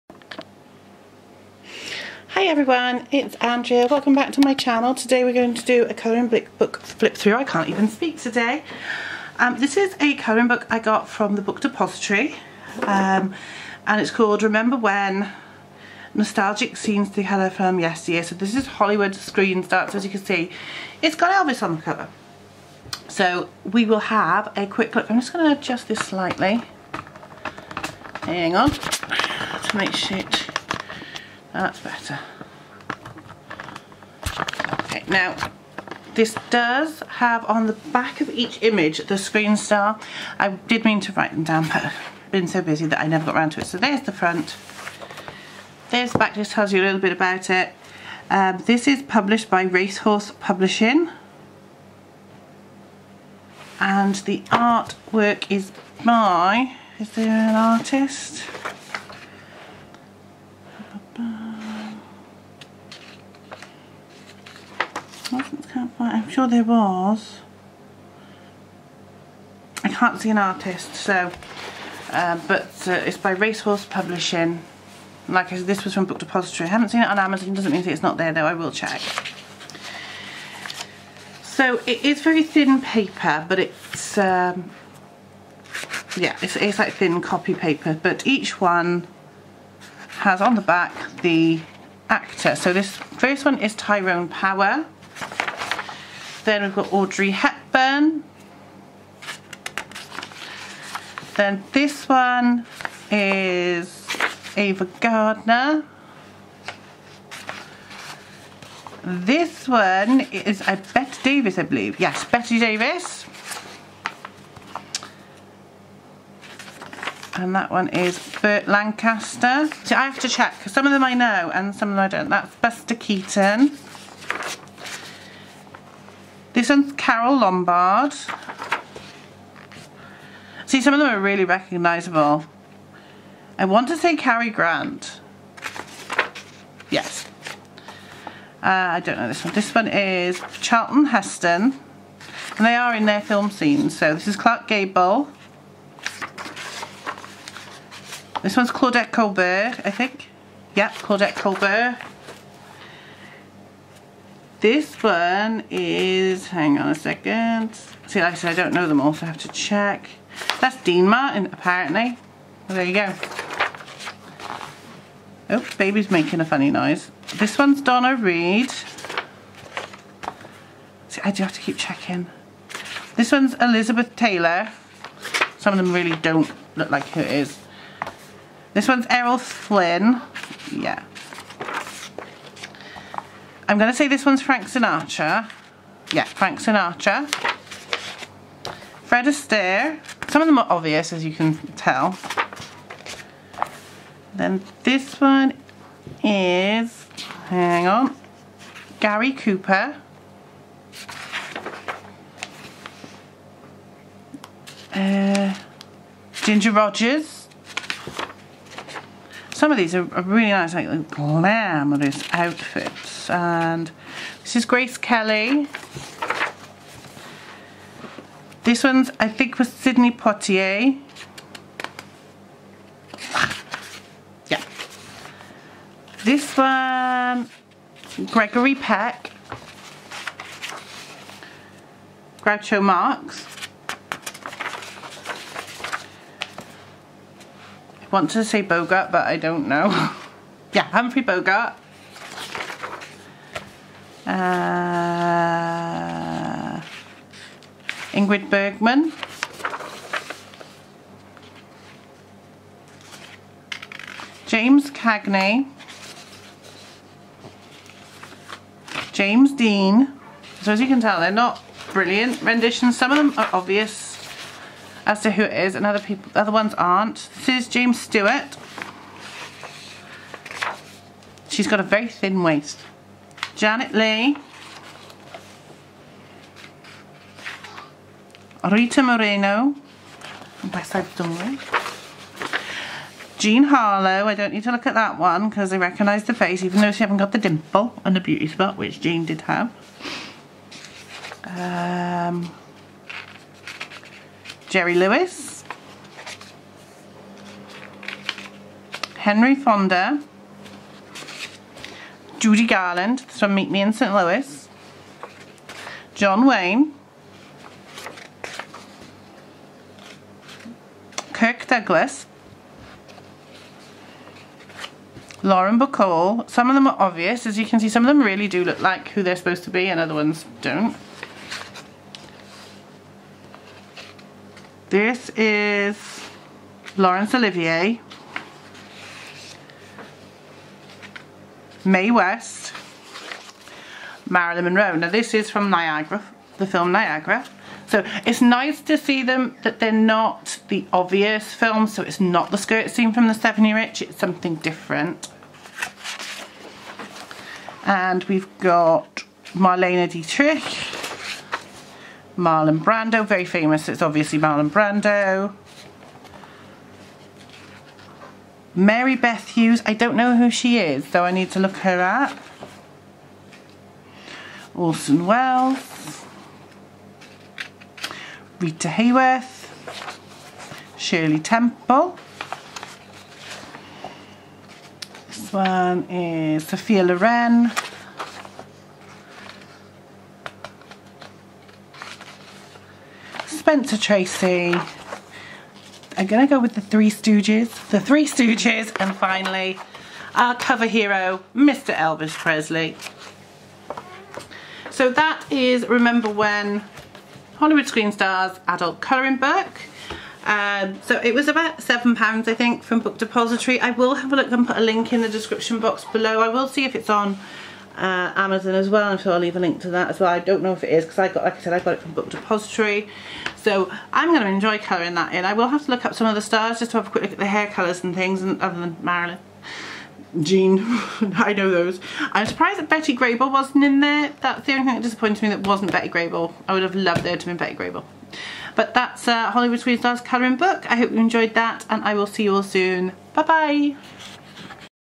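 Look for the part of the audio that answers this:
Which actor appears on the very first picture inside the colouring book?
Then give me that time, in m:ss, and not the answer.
1:33.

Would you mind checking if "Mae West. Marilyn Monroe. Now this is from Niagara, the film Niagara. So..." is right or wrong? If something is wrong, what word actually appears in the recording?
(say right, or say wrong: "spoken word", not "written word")
right.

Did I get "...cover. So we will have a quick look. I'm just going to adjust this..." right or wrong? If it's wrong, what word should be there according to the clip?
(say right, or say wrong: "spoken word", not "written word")
right.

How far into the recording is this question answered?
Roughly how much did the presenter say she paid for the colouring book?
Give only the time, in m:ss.
6:41.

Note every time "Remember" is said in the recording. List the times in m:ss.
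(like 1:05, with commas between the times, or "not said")
0:14, 6:35.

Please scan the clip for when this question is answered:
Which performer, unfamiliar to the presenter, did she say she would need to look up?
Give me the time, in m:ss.
5:58.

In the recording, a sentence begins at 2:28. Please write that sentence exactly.
This one's Claudette Colbert, I think.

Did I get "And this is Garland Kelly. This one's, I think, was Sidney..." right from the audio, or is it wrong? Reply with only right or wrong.
wrong.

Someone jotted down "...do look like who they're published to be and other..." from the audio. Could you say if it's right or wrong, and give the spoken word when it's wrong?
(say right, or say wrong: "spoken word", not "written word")
wrong: "supposed", not "published".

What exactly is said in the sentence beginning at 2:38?
See, like I said, I don't know them all, so I have to check.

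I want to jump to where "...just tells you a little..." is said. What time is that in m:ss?
0:46.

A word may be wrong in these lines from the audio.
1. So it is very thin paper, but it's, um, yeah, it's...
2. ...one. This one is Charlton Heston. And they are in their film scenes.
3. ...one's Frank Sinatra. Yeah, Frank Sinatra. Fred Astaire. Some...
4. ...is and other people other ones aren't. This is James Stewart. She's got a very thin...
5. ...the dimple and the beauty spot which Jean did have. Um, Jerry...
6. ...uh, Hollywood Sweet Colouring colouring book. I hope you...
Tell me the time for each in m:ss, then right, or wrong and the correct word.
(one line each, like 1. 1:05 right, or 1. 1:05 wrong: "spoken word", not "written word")
1. 1:21 right
2. 2:19 right
3. 3:04 right
4. 4:25 right
5. 4:47 right
6. 7:09 wrong: "Stars", not "Colouring".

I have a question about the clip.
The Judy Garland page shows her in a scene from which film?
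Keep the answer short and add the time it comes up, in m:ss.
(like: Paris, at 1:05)
Meet Me in St. Louis, at 5:03.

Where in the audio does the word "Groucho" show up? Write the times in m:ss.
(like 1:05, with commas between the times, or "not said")
3:52.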